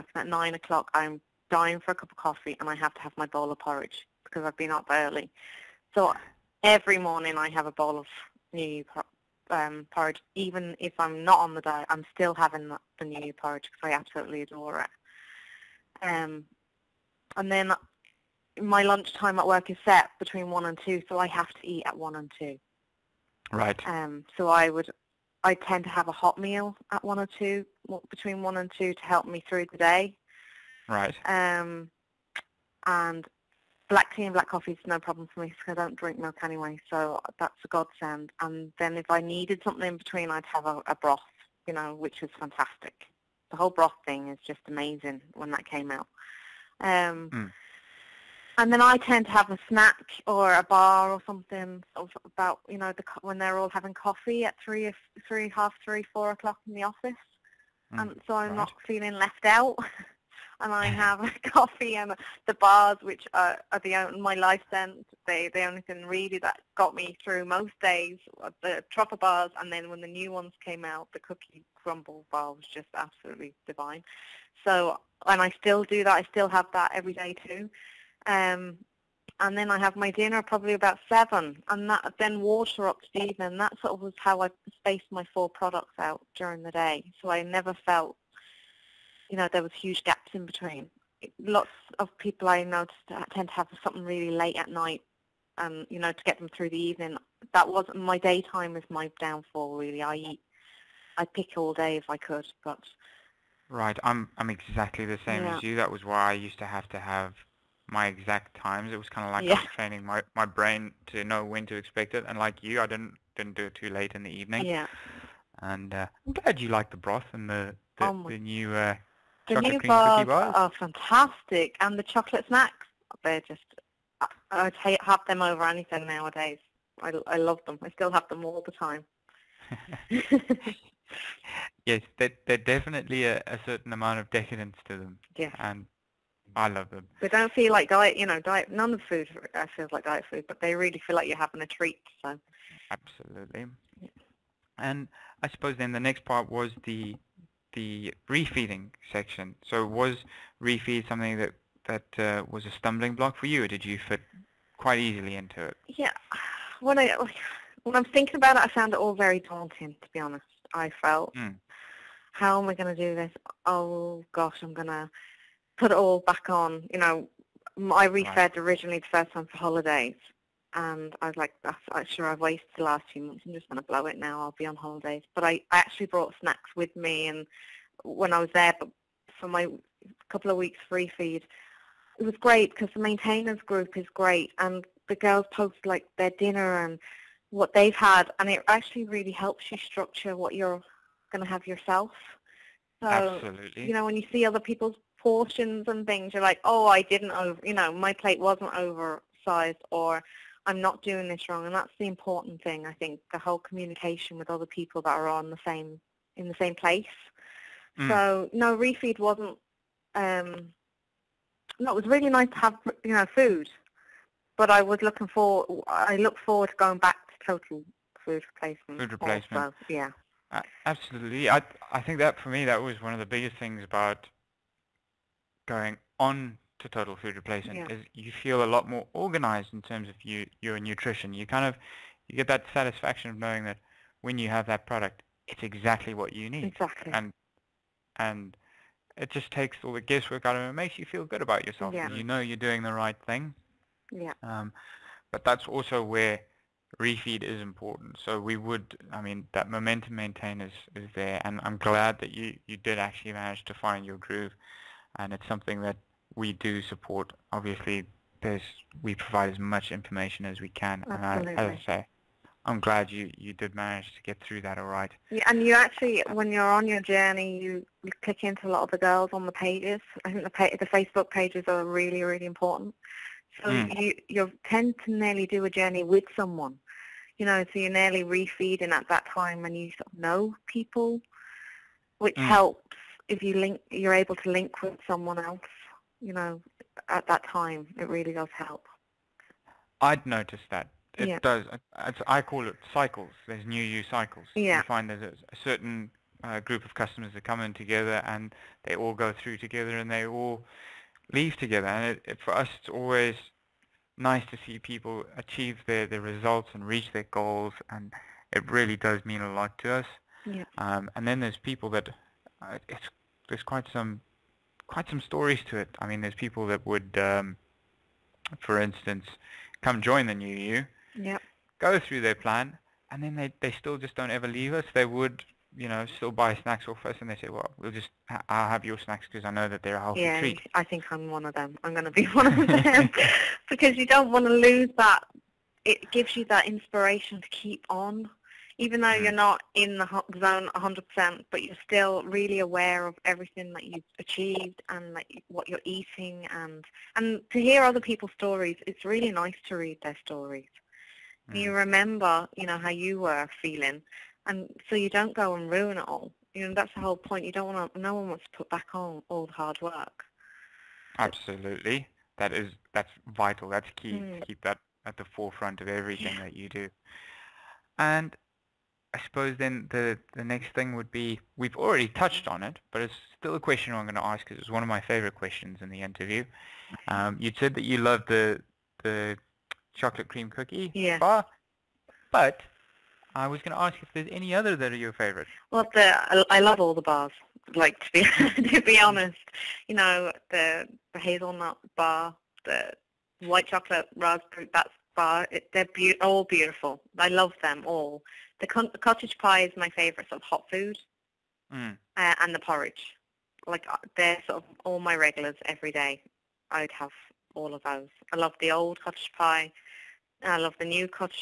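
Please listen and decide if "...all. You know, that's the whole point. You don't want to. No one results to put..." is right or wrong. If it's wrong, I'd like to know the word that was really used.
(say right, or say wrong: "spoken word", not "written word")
wrong: "wants", not "results".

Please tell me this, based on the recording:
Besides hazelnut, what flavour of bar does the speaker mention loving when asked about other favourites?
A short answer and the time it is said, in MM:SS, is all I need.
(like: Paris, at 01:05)
white chocolate raspberry, at 06:33.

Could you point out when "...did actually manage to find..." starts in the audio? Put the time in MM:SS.
04:12.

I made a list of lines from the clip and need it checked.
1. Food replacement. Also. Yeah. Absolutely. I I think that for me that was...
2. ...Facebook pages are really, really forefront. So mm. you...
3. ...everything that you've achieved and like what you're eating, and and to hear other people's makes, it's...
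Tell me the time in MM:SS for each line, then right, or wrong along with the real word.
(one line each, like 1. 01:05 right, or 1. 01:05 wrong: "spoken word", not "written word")
1. 03:38 right
2. 04:30 wrong: "important", not "forefront"
3. 05:43 wrong: "stories", not "makes".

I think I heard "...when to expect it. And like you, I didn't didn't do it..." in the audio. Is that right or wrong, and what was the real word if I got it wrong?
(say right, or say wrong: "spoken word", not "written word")
right.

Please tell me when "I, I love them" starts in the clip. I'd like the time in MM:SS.
02:07.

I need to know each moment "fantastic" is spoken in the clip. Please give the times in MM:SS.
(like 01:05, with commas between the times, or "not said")
00:42, 02:00.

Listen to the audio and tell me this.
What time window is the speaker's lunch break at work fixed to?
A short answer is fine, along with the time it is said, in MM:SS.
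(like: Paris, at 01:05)
1 to 2, at 00:19.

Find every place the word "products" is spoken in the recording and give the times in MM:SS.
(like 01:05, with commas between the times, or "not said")
01:25, 03:54.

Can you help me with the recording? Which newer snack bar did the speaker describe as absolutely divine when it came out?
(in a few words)
Cookie Crumble bar.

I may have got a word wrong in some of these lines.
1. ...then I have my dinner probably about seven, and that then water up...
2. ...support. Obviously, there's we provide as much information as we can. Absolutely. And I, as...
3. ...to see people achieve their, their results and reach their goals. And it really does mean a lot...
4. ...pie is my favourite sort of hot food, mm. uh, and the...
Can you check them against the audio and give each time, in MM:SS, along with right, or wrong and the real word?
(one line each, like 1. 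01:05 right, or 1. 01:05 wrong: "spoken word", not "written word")
1. 01:19 right
2. 04:16 right
3. 05:04 right
4. 06:39 right.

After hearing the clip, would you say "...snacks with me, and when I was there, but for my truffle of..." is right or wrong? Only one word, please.
wrong.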